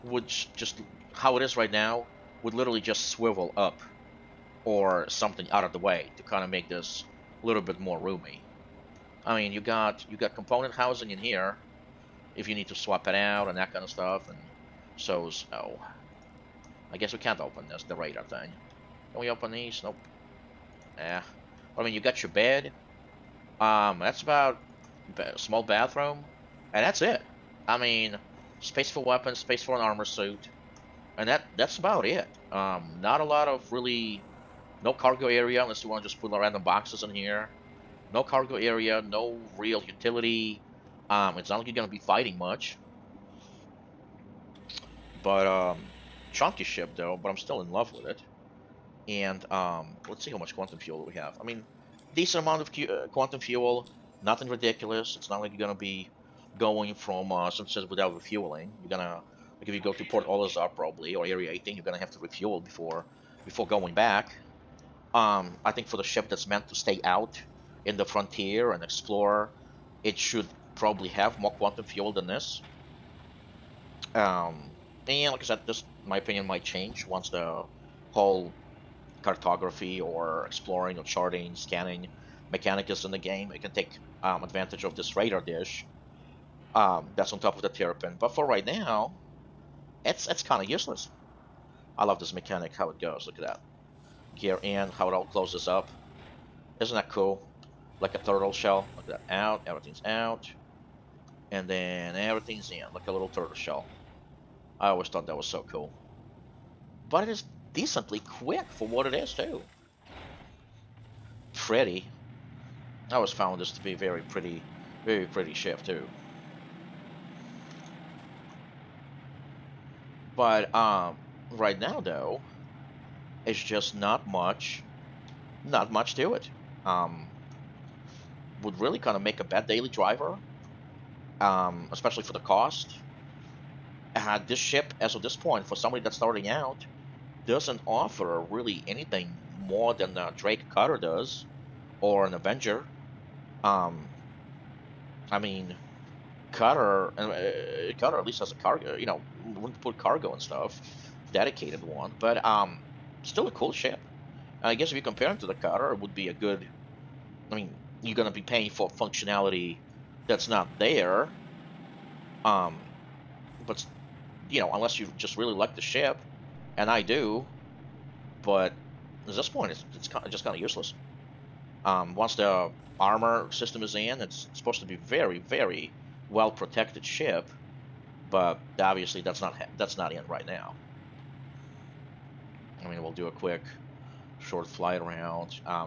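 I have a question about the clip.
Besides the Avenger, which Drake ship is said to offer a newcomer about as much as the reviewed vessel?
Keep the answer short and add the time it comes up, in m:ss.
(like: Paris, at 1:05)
Drake Cutter, at 2:20.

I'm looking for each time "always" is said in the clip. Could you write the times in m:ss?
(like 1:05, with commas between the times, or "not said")
1:44, 1:53.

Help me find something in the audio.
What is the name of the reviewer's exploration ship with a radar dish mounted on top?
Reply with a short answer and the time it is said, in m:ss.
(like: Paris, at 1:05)
Terrapin, at 1:27.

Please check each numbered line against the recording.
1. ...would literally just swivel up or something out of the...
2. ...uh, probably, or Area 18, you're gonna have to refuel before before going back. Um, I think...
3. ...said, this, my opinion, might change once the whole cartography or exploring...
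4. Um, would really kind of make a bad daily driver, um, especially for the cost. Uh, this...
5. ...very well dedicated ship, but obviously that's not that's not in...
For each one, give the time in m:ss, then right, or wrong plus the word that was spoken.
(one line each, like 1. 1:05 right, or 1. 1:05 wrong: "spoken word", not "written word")
1. 0:02 right
2. 1:00 right
3. 1:15 right
4. 2:06 right
5. 2:55 wrong: "protected", not "dedicated".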